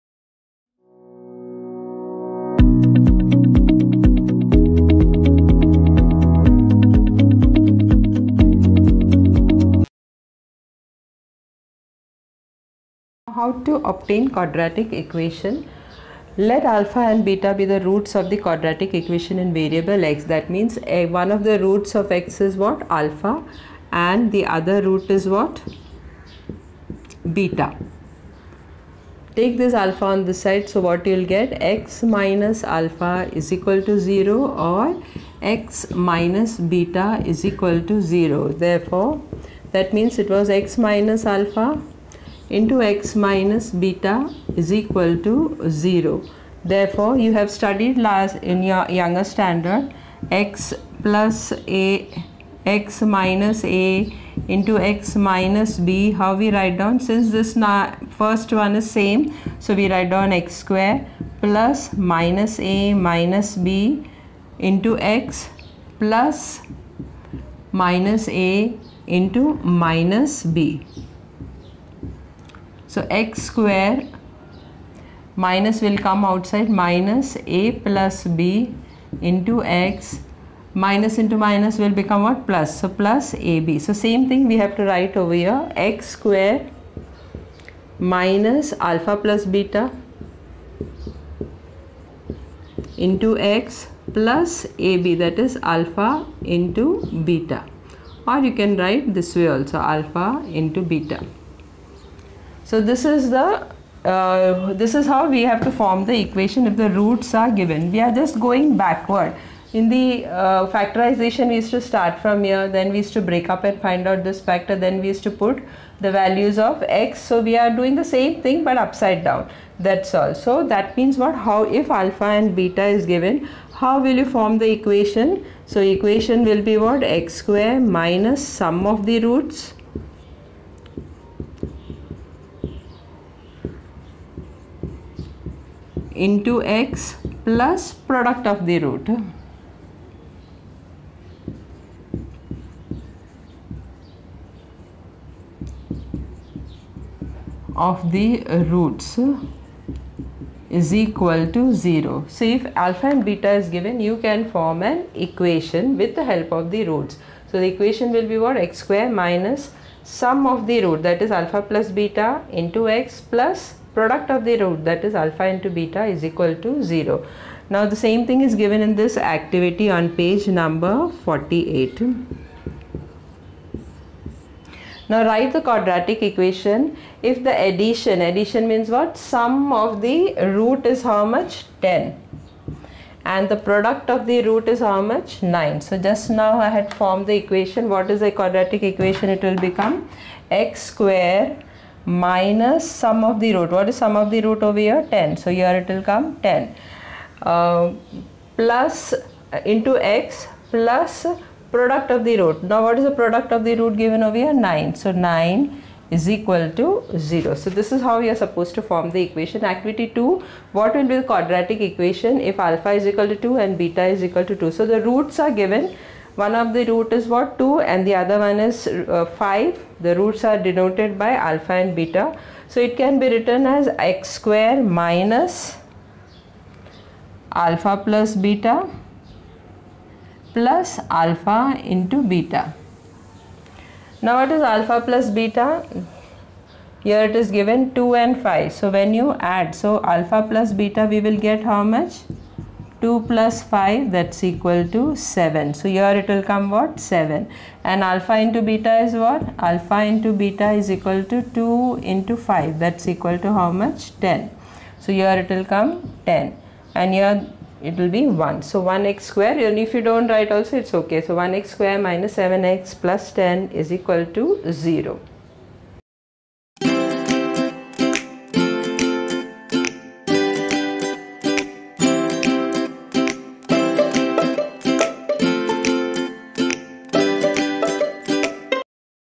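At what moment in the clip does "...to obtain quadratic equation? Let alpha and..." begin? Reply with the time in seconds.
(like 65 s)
13 s.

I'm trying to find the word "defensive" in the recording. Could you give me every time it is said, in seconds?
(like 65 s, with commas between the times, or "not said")
not said.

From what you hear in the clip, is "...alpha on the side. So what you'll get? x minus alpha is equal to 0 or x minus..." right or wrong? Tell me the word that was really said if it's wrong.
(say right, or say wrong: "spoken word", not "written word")
right.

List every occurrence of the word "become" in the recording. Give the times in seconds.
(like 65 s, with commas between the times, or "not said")
82 s, 189 s.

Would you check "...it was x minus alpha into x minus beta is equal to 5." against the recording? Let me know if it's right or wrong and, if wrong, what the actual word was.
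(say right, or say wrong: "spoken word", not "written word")
wrong: "0", not "5".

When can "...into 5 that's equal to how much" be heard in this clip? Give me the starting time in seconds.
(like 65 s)
252 s.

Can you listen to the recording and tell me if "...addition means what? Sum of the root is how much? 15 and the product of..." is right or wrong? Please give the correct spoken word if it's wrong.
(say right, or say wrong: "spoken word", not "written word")
wrong: "10", not "15".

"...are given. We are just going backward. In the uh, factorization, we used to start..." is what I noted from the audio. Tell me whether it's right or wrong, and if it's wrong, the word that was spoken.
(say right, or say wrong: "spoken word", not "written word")
right.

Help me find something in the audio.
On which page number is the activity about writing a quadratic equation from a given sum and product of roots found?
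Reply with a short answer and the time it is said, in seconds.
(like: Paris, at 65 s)
48, at 171 s.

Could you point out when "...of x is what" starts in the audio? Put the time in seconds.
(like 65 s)
21 s.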